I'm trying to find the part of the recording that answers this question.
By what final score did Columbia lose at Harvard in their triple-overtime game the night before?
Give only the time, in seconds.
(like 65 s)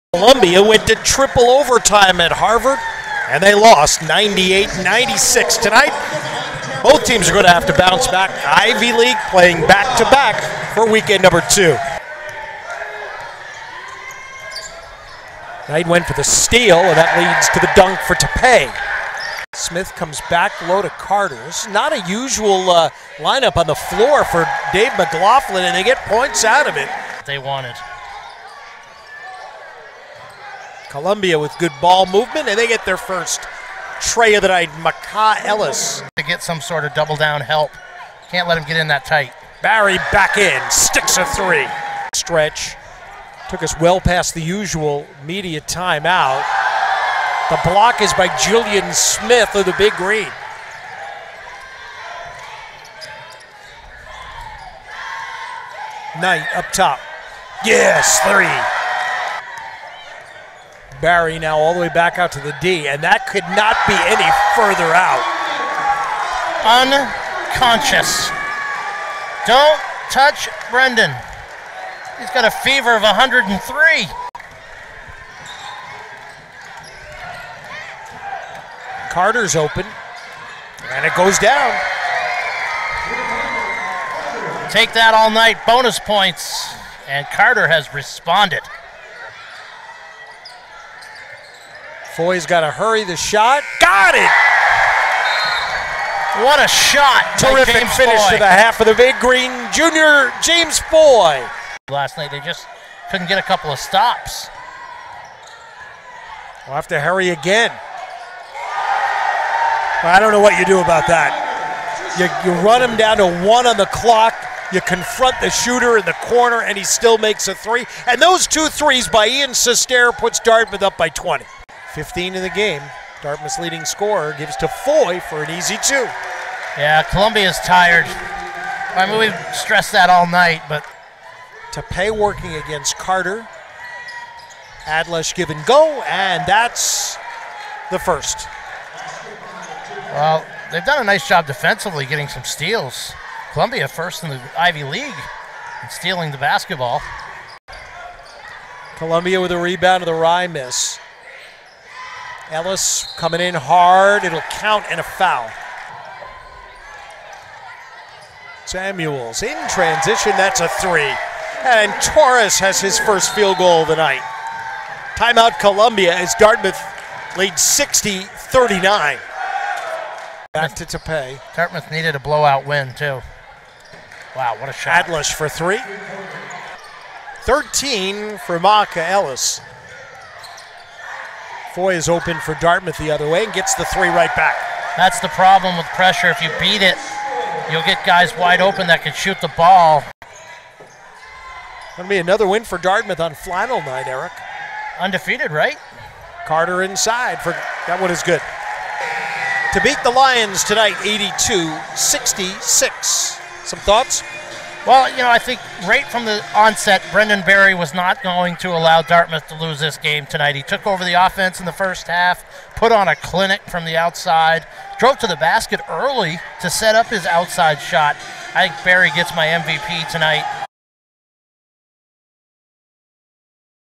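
4 s.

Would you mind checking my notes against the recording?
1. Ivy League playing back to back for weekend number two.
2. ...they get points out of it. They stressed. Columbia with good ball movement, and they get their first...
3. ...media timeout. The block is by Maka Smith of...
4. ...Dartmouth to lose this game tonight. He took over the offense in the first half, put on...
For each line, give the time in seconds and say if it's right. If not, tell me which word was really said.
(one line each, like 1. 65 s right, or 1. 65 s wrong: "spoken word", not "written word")
1. 8 s right
2. 25 s wrong: "wanted", not "stressed"
3. 45 s wrong: "Guilien", not "Maka"
4. 209 s right.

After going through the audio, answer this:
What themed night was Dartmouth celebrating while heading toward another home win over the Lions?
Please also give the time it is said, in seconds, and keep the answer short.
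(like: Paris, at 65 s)
flannel night, at 193 s.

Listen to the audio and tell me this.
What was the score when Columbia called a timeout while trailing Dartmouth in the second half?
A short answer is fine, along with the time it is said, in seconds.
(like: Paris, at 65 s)
60-39, at 167 s.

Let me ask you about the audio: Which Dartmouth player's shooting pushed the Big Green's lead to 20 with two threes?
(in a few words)
Ian Sistare.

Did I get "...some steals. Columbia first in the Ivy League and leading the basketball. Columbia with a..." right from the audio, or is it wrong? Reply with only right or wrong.
wrong.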